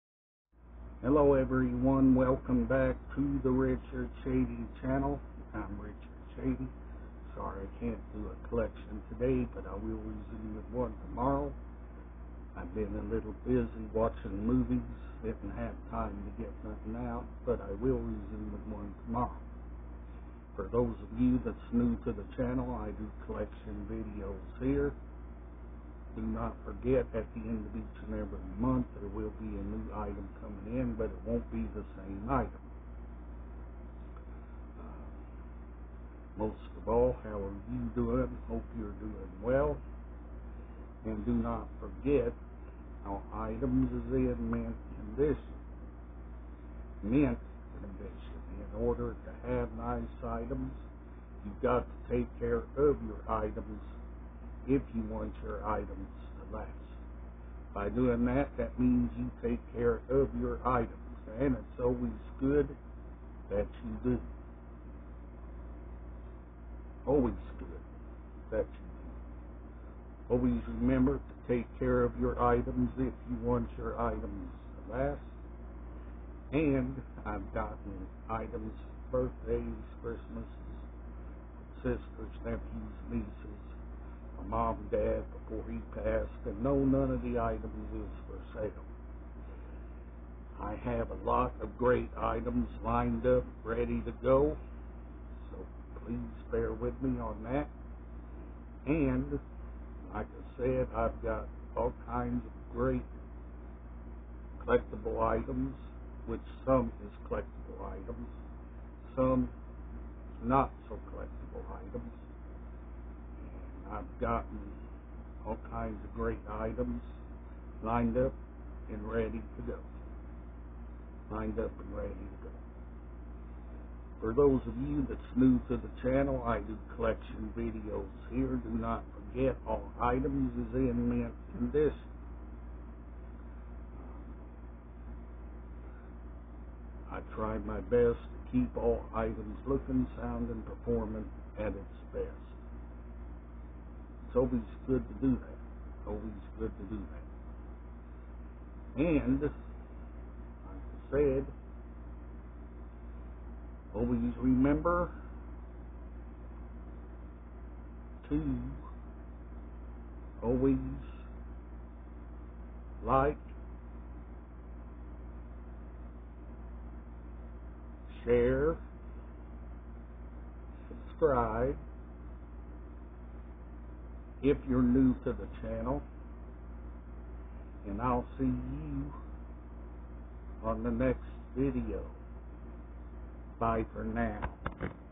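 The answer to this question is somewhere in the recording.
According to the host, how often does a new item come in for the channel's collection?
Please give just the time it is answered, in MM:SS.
00:27.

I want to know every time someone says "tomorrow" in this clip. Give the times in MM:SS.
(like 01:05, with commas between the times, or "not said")
00:11, 00:19.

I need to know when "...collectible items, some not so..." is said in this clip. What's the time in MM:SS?
01:47.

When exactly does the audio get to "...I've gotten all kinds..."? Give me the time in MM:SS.
01:54.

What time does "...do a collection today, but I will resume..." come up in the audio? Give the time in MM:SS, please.
00:08.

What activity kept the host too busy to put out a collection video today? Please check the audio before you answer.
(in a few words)
watching movies.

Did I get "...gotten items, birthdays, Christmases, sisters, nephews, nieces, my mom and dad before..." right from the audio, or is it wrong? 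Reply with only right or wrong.
right.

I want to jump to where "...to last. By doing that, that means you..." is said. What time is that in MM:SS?
00:56.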